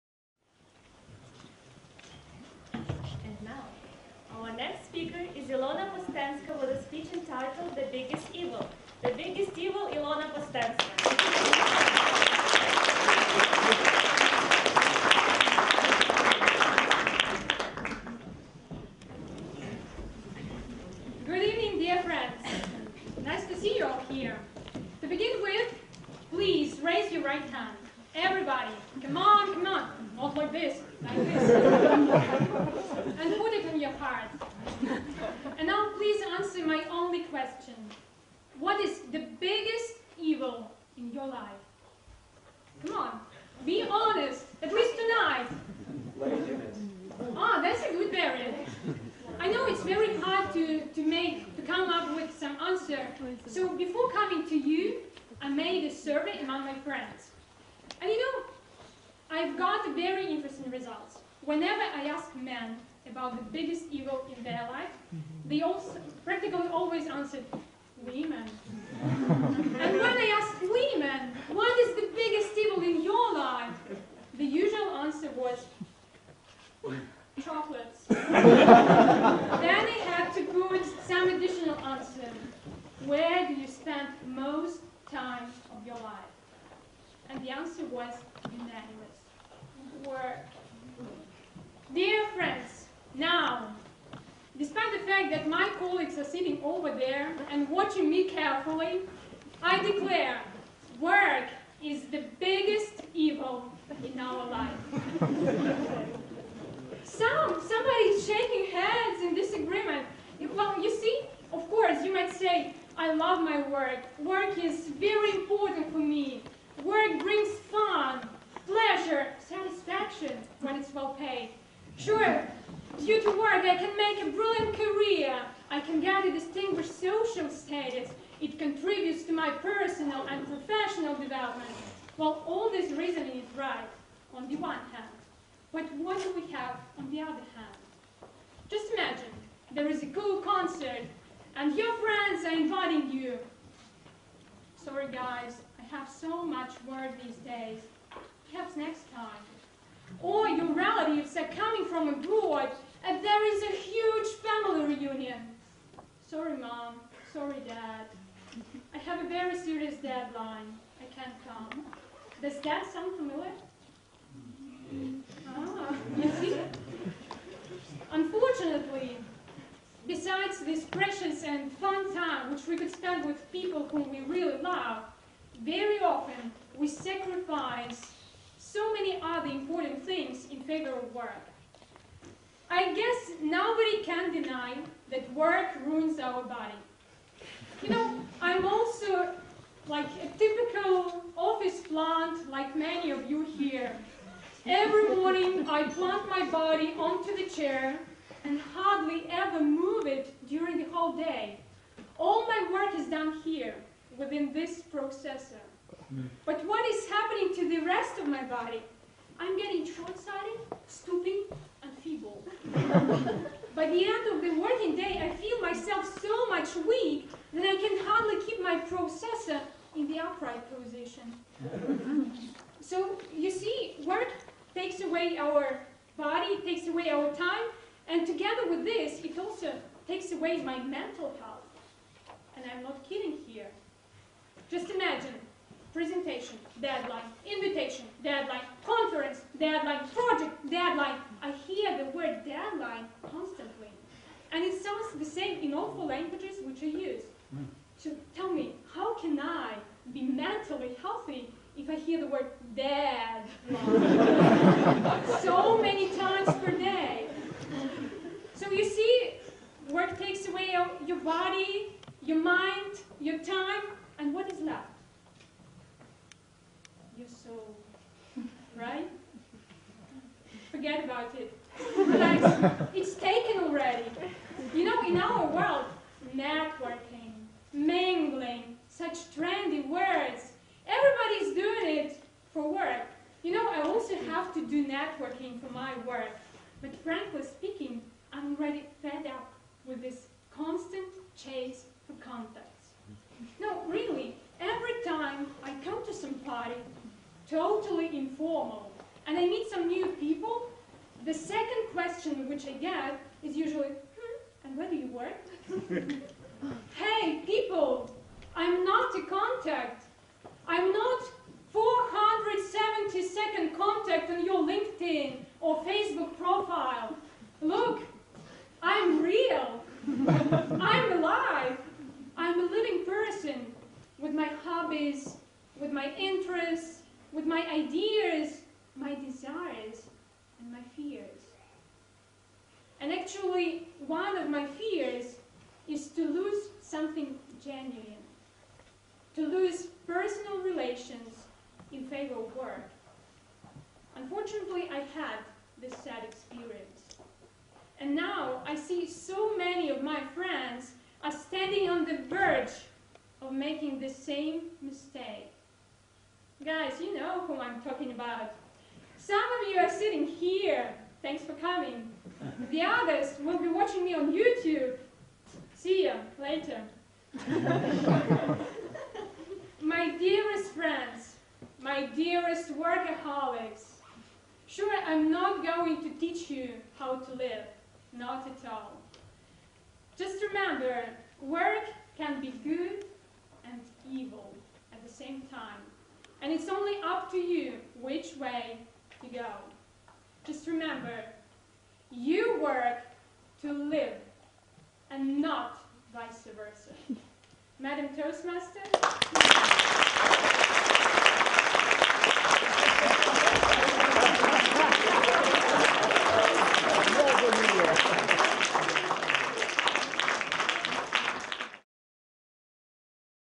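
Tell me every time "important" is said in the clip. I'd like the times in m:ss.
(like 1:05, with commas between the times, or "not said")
1:55, 2:59.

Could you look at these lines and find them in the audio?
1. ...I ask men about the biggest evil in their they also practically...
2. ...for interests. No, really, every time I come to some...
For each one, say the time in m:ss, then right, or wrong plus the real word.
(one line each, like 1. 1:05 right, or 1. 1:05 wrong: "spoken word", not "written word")
1. 1:01 right
2. 4:52 wrong: "contacts", not "interests".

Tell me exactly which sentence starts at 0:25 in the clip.
To begin with, please raise your right hand.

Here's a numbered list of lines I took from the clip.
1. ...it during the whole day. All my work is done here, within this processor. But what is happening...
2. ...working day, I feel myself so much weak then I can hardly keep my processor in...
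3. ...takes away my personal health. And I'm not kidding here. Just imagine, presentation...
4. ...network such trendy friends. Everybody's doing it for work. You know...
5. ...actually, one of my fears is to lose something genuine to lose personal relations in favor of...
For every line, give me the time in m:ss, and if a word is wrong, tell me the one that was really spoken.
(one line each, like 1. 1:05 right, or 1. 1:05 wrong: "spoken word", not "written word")
1. 3:20 right
2. 3:34 right
3. 3:50 wrong: "mental", not "personal"
4. 4:36 wrong: "words", not "friends"
5. 5:33 right.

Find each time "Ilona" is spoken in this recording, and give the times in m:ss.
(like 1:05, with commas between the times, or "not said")
0:05, 0:09.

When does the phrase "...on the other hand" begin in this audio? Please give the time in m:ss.
2:16.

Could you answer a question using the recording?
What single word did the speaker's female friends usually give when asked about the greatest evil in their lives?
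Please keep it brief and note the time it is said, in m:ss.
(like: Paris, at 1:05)
Chocolates, at 1:17.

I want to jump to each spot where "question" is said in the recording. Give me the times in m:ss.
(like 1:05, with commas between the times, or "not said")
0:37, 5:01.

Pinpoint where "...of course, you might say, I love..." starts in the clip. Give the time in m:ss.
1:51.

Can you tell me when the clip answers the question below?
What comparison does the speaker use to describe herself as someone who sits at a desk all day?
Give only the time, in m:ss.
3:10.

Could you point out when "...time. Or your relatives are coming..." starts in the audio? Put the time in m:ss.
2:29.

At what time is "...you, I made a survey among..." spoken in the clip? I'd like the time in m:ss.
0:54.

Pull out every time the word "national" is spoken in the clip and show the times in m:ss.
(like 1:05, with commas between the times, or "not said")
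not said.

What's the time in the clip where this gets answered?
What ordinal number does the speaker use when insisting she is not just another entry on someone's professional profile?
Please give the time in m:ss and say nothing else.
5:11.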